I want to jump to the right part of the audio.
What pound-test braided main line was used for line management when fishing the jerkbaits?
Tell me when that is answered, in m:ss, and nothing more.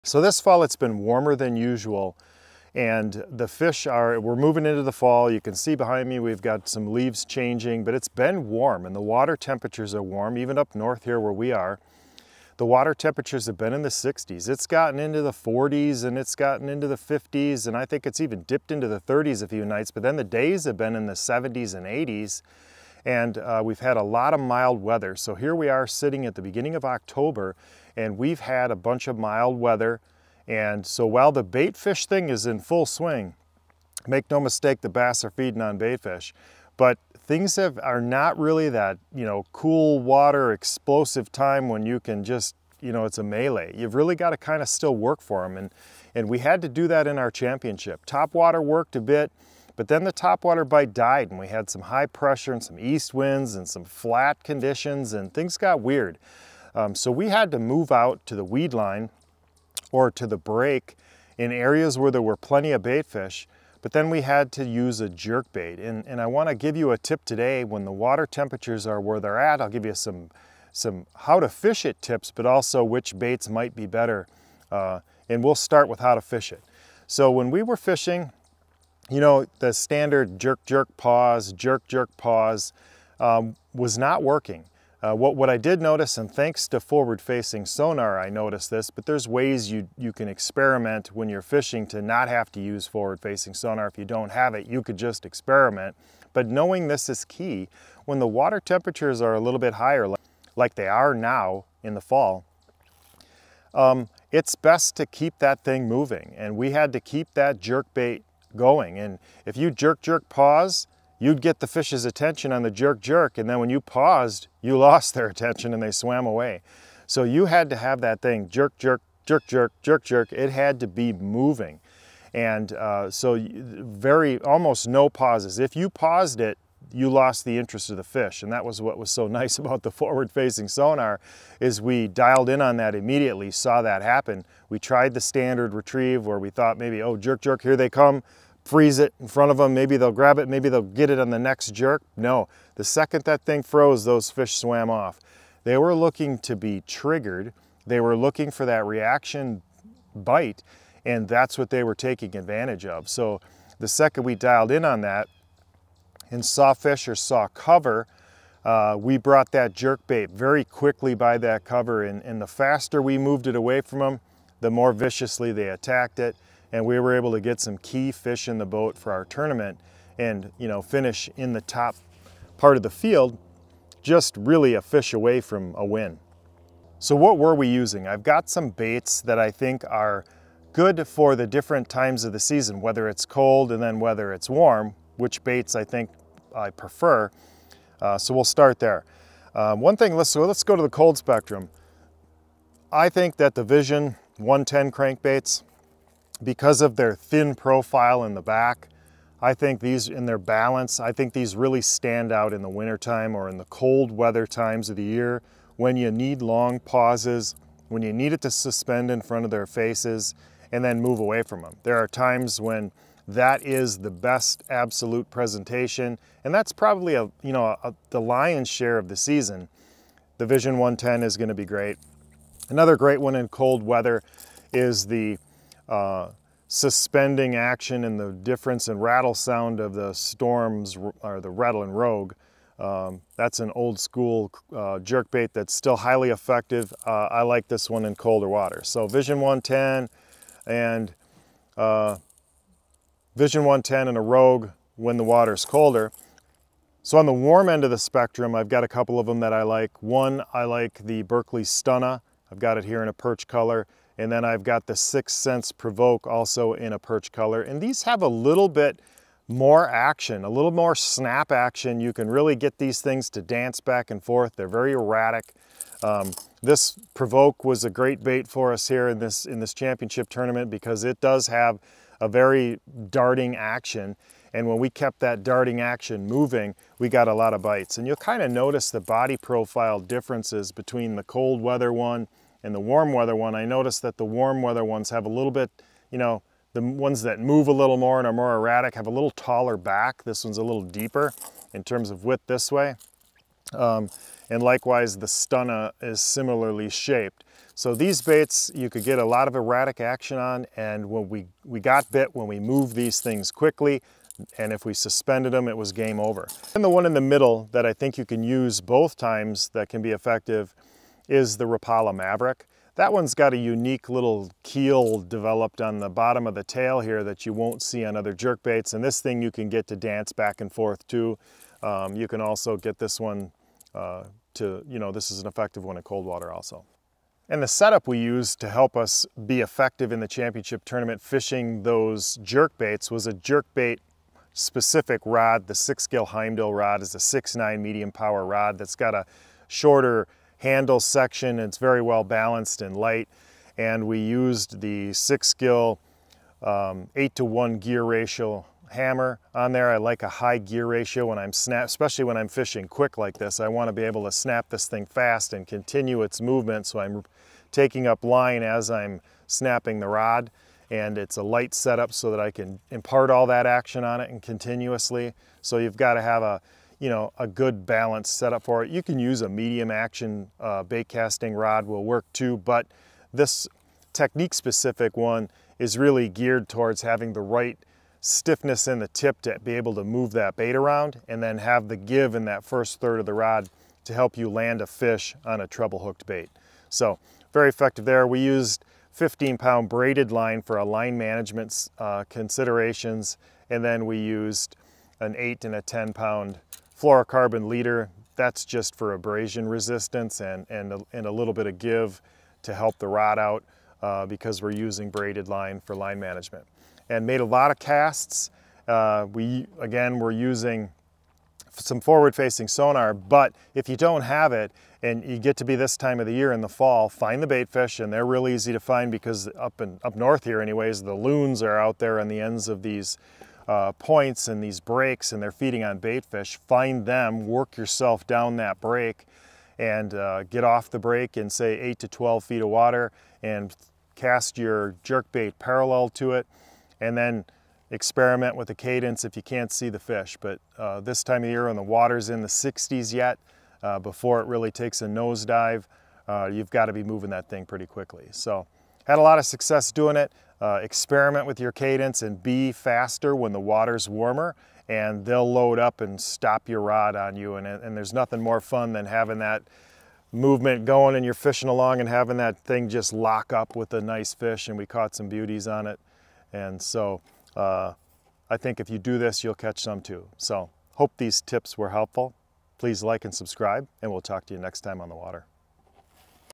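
6:29.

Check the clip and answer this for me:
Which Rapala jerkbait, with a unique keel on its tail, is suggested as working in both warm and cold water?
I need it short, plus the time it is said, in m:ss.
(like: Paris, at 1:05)
Mavrik, at 5:11.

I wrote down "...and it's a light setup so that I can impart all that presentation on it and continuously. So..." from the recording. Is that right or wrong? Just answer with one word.
wrong.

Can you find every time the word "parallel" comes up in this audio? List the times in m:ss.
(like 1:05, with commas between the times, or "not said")
7:15.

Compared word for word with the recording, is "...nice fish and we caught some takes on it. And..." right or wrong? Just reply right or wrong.
wrong.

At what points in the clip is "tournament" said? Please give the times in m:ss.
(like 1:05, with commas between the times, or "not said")
2:49, 4:30, 5:30.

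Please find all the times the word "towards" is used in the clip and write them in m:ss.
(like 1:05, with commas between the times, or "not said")
6:16.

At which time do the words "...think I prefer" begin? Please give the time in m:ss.
3:05.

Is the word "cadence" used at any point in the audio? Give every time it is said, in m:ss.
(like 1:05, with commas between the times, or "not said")
7:18, 7:31.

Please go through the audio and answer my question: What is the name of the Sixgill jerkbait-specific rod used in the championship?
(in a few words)
Heimdall.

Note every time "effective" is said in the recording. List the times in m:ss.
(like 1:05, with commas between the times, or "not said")
3:56, 5:10, 5:25, 5:29, 6:27.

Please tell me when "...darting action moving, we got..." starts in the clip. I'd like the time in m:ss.
4:35.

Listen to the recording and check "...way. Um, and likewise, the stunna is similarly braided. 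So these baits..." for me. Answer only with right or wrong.
wrong.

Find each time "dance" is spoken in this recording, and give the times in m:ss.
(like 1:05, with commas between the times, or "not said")
4:23, 5:19.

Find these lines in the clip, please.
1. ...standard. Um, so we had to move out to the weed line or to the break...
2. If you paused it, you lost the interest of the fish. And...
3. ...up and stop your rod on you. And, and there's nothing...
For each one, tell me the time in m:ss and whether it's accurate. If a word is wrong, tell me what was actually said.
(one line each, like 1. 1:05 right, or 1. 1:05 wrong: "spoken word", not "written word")
1. 0:55 wrong: "weird", not "standard"
2. 2:05 right
3. 7:35 right.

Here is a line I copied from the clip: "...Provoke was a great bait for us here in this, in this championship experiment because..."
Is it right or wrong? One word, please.
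wrong.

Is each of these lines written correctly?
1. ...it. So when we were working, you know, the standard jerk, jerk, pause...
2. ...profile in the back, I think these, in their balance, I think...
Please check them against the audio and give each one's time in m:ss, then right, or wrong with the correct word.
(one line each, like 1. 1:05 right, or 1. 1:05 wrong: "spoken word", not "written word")
1. 1:16 wrong: "fishing", not "working"
2. 3:17 right.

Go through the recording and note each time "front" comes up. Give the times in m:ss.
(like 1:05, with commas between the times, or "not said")
2:19, 3:29.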